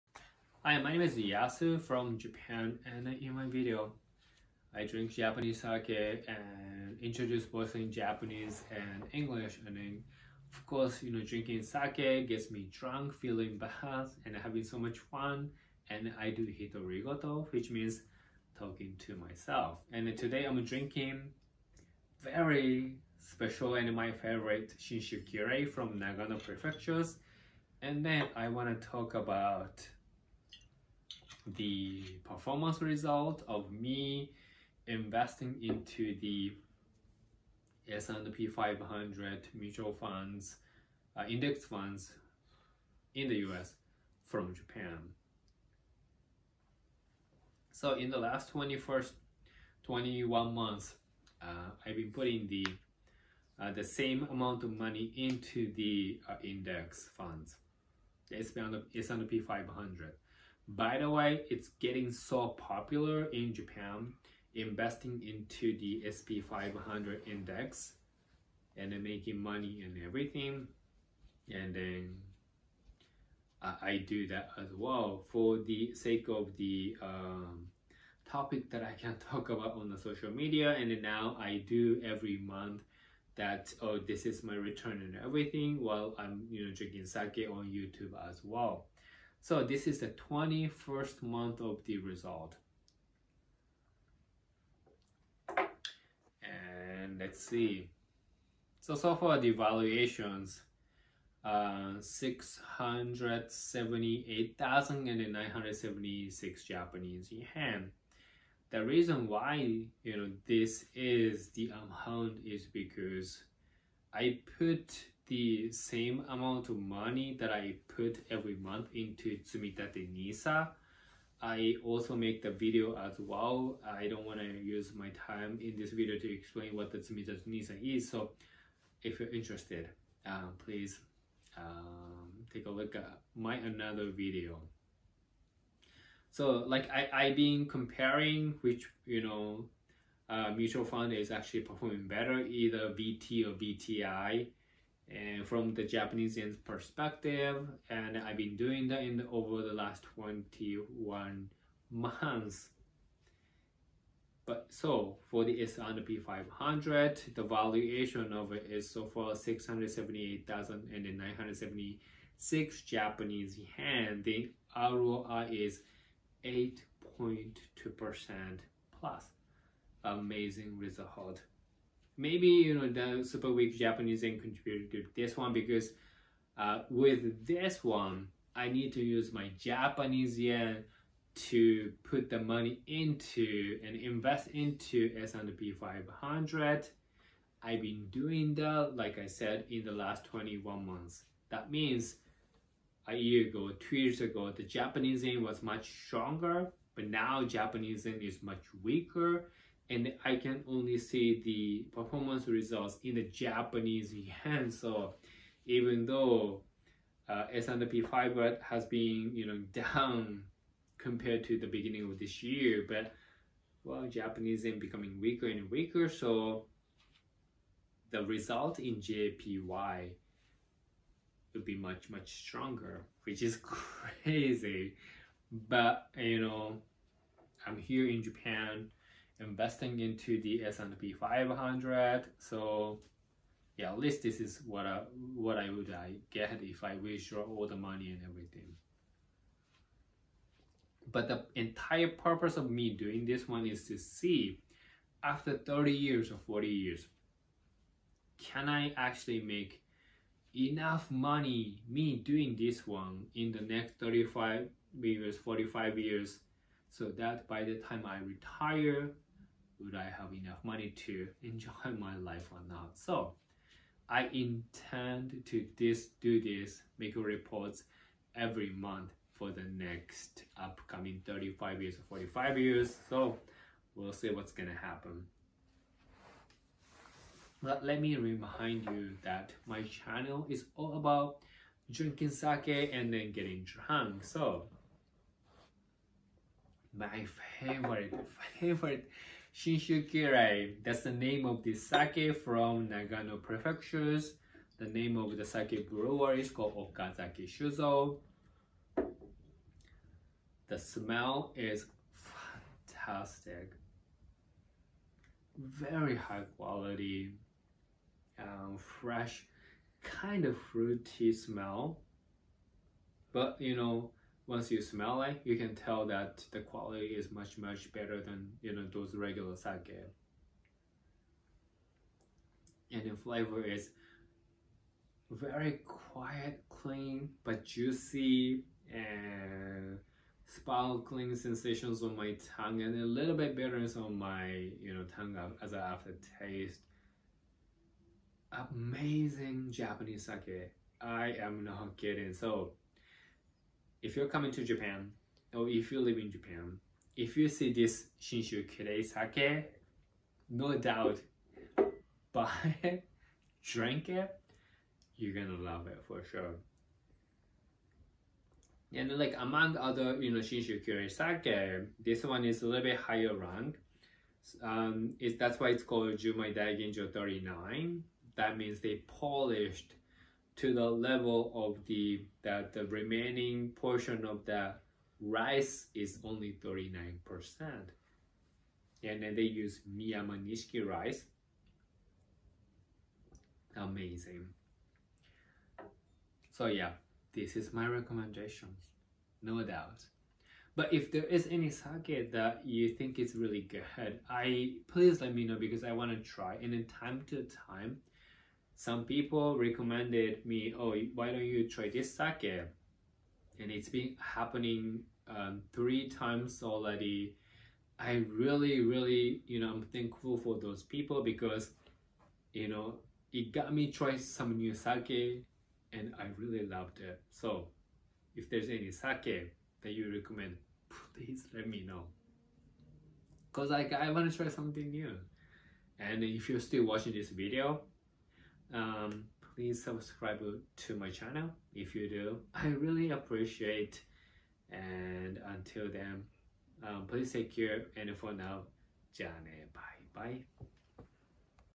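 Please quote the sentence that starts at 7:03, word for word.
Cause like I want to try something new.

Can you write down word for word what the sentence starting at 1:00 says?
By the way, it's getting so popular in Japan, investing into the SP500 index and then making money and everything.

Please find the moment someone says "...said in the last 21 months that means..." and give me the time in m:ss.
3:09.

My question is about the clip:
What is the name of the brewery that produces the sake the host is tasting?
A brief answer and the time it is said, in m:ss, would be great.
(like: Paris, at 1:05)
Okazaki Shuzo, at 4:56.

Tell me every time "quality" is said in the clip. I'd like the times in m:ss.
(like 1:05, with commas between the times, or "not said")
5:06, 5:16.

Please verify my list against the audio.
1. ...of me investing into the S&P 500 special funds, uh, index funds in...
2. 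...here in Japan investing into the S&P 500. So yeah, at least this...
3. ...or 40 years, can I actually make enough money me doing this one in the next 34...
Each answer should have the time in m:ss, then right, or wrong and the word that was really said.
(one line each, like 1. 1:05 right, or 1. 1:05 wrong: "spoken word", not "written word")
1. 0:33 wrong: "mutual", not "special"
2. 3:47 right
3. 4:06 wrong: "35", not "34".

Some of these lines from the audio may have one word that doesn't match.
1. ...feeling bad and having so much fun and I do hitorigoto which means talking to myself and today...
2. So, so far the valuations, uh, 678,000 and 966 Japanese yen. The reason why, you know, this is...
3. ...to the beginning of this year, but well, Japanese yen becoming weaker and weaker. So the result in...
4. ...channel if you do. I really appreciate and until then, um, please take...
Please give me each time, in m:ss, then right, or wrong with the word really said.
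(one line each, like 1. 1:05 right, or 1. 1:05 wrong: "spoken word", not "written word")
1. 0:13 right
2. 1:38 wrong: "976", not "966"
3. 3:31 right
4. 7:11 right.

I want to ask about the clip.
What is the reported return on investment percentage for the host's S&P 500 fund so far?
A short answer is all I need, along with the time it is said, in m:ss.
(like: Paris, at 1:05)
8.2%, at 2:46.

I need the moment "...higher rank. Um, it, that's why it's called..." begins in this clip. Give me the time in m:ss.
6:02.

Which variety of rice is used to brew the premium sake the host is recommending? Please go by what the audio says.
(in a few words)
Miyamanishiki.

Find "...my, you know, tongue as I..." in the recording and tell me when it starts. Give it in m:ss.
5:34.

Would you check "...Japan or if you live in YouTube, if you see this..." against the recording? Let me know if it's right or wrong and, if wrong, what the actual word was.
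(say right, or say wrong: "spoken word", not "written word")
wrong: "Japan", not "YouTube".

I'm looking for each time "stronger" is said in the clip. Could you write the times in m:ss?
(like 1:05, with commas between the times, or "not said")
3:16, 3:42.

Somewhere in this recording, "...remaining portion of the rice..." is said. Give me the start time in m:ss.
6:12.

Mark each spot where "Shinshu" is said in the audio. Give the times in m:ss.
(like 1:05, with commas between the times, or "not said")
0:24, 5:48, 6:00.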